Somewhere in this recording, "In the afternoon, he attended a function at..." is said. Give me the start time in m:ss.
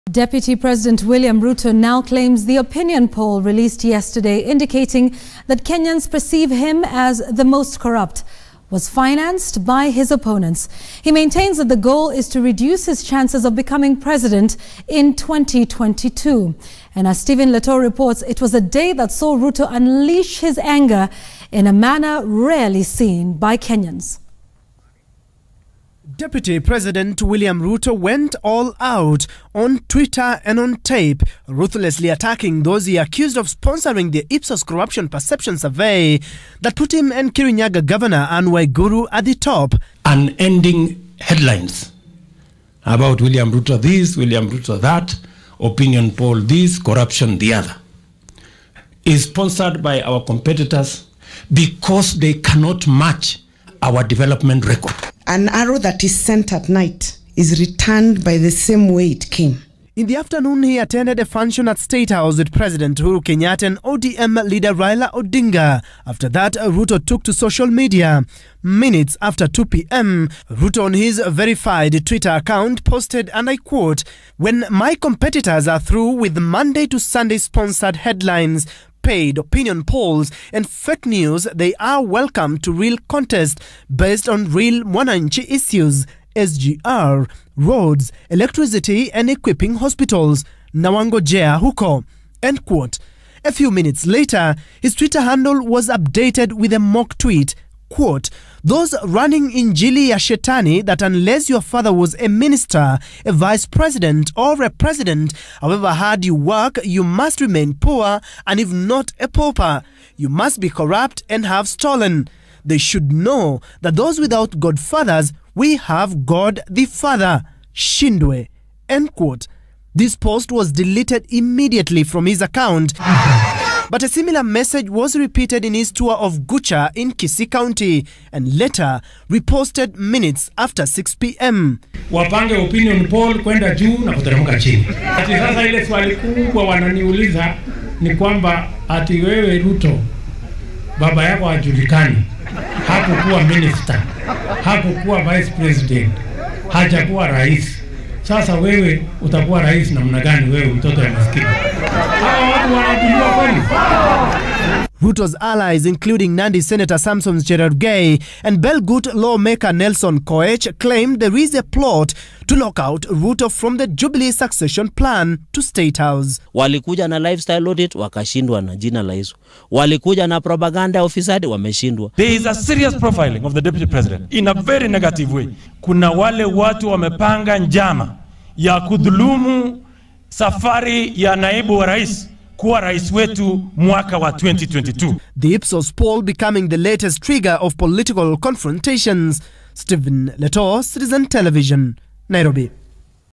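0:59.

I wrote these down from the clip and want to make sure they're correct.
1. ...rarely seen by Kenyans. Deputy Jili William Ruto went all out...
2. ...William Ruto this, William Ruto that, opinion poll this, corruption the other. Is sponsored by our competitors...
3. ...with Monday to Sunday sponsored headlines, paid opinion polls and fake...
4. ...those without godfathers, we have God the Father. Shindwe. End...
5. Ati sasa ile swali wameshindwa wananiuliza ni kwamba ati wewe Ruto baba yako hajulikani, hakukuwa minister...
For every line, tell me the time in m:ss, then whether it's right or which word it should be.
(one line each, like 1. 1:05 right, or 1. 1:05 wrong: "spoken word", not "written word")
1. 0:22 wrong: "President", not "Jili"
2. 0:43 right
3. 1:16 right
4. 1:53 right
5. 2:15 wrong: "kubwa", not "wameshindwa".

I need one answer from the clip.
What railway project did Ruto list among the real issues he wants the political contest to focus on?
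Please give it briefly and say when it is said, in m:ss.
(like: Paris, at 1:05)
SGR, at 1:26.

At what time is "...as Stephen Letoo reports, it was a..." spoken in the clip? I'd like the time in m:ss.
0:17.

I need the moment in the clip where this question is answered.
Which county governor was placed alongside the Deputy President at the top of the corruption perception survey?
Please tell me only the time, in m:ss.
0:37.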